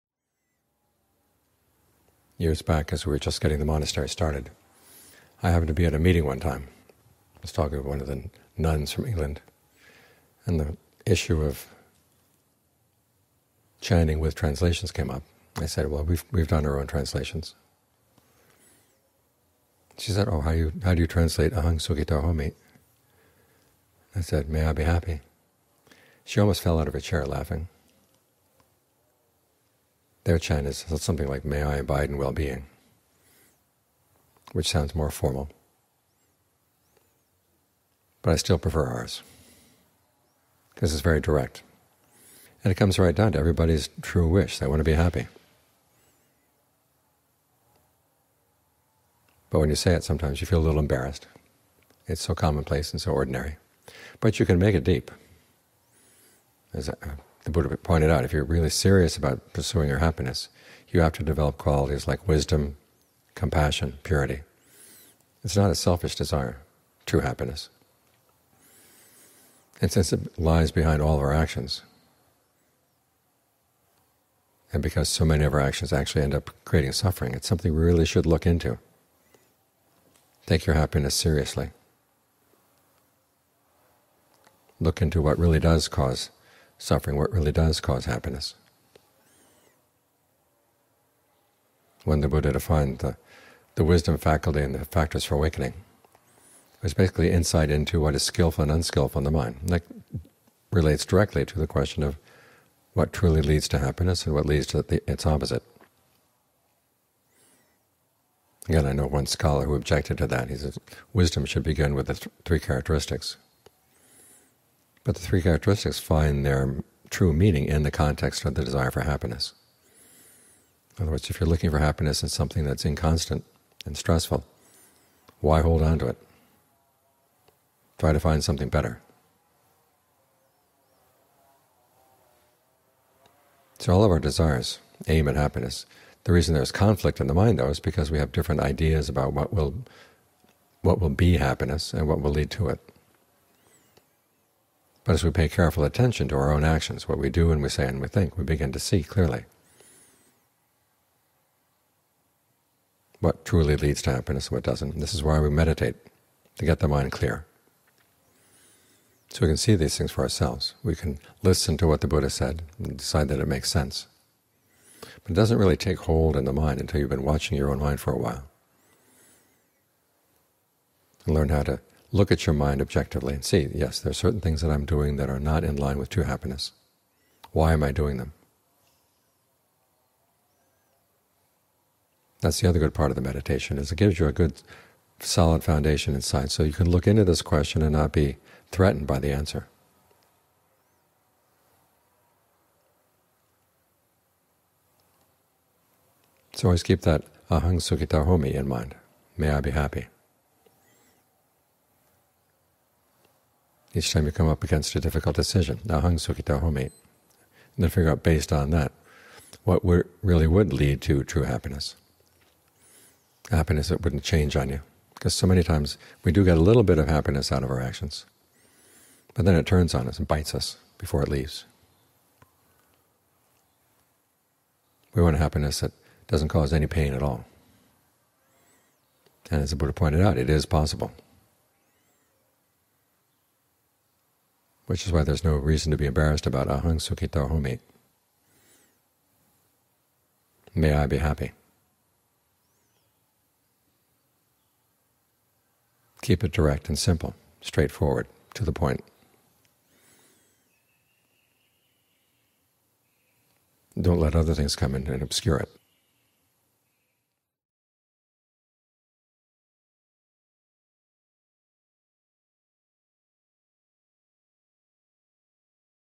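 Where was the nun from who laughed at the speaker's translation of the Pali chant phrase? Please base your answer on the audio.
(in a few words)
England.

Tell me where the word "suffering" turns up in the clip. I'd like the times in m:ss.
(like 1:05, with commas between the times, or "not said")
1:16, 1:26.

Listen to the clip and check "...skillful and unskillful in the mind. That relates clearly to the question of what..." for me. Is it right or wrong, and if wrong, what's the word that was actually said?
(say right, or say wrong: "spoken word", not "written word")
wrong: "directly", not "clearly".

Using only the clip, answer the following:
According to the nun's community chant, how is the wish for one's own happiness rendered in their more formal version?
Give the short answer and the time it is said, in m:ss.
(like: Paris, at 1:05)
May I abide in well-being, at 0:31.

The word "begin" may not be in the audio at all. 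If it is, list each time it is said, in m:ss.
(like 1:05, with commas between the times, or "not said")
1:51, 2:28.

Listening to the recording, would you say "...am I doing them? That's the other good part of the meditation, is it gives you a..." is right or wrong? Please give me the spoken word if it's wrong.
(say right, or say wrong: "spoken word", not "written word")
right.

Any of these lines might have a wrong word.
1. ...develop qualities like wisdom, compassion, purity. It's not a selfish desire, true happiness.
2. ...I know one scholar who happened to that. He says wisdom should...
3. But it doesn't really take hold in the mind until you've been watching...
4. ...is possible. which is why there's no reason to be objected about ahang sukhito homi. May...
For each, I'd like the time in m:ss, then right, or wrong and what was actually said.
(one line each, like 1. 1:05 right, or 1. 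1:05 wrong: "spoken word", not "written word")
1. 1:01 right
2. 1:48 wrong: "objected", not "happened"
3. 2:45 right
4. 3:50 wrong: "embarrassed", not "objected".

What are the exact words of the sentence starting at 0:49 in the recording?
But when you say it, sometimes you feel a little embarrassed.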